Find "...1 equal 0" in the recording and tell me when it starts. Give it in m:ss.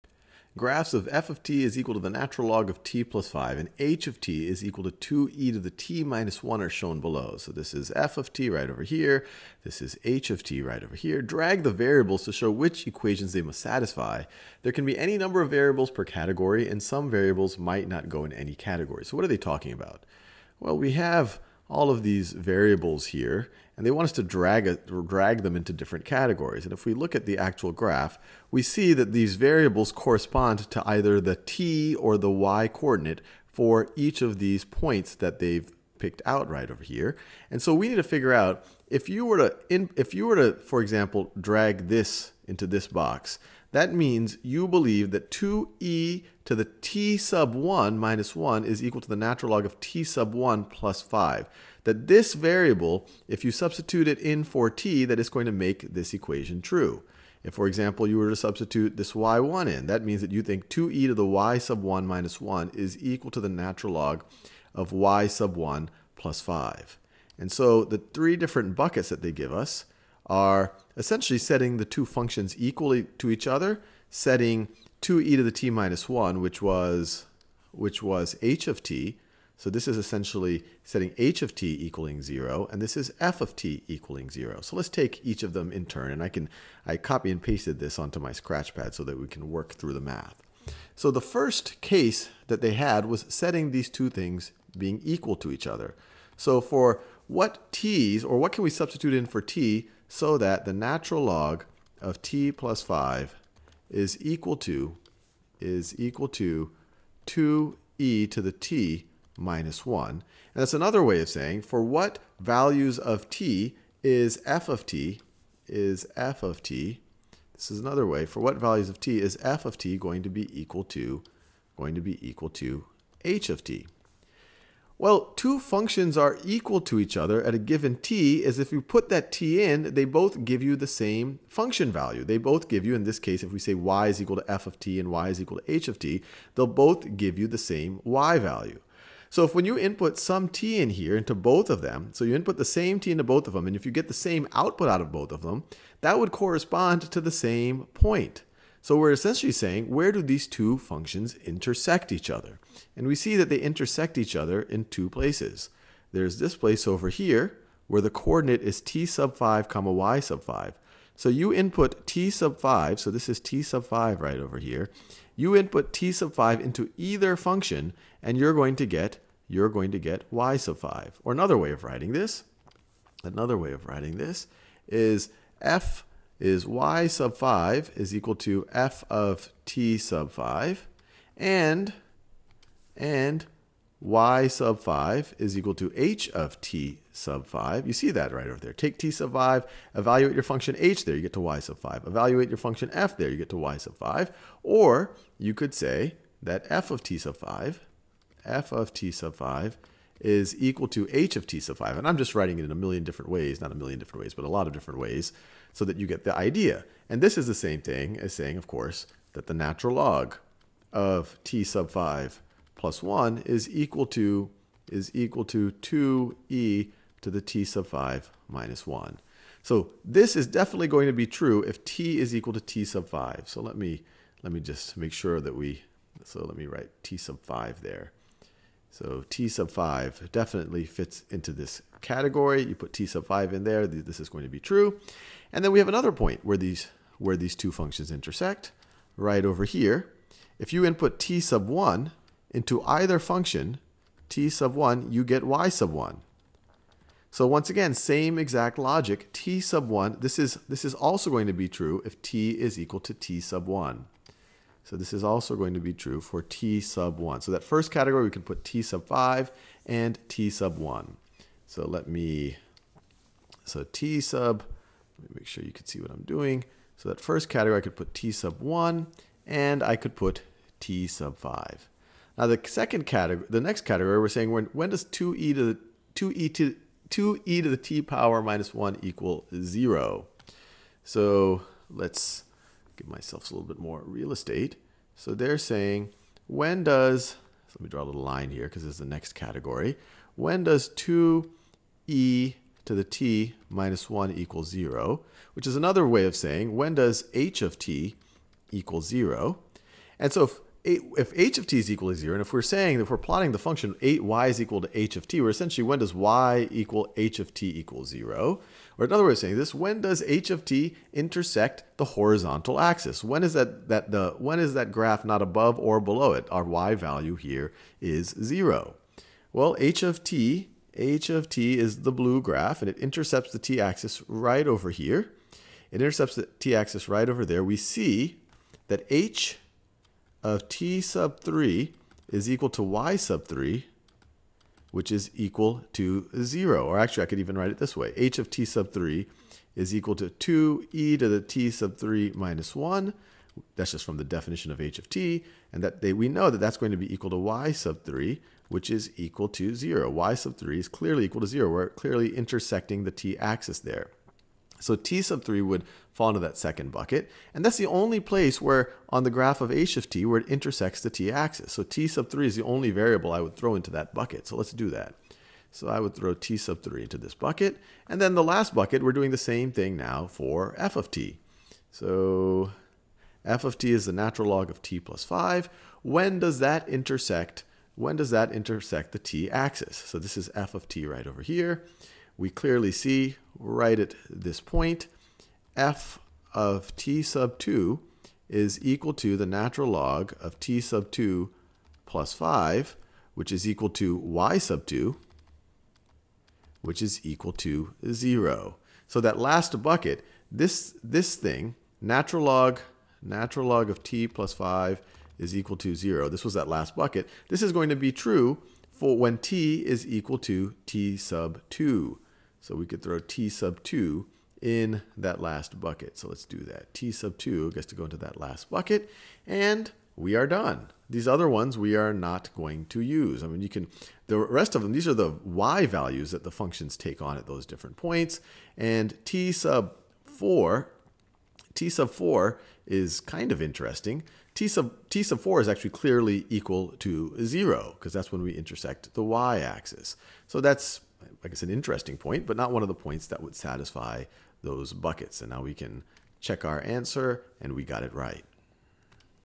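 4:38.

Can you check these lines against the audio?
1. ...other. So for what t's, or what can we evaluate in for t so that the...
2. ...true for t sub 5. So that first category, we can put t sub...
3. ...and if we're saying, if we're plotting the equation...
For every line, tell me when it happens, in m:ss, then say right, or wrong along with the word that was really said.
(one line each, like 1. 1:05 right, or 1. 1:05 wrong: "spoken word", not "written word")
1. 1:35 wrong: "substitute", not "evaluate"
2. 4:15 wrong: "1", not "5"
3. 5:02 wrong: "function", not "equation".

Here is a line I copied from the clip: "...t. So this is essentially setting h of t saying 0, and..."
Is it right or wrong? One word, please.
wrong.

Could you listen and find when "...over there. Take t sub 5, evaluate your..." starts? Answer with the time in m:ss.
3:08.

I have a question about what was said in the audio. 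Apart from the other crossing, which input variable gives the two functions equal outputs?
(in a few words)
t sub 1.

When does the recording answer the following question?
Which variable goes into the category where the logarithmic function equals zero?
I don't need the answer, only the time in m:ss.
6:56.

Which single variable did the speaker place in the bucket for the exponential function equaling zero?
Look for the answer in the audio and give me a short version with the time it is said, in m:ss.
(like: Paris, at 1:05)
t sub 3, at 6:05.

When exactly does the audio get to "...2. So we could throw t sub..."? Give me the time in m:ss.
6:51.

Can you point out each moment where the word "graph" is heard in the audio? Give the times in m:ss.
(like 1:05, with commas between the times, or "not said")
0:00, 0:27, 5:14, 5:22, 5:59.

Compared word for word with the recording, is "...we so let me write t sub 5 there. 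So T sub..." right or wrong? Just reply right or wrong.
right.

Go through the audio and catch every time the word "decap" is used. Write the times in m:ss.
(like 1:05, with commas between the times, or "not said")
not said.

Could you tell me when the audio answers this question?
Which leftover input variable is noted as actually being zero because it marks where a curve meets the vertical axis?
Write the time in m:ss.
7:15.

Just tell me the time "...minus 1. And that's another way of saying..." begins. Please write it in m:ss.
1:49.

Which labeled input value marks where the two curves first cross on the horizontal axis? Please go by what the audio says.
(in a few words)
t sub 5.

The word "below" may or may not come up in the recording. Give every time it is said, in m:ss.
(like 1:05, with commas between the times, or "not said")
0:06, 5:15.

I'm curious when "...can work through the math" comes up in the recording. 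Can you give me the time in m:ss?
1:29.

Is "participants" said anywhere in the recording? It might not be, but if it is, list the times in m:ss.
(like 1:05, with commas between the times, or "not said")
not said.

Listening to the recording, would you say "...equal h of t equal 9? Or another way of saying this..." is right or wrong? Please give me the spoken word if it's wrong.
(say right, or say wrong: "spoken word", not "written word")
wrong: "0", not "9".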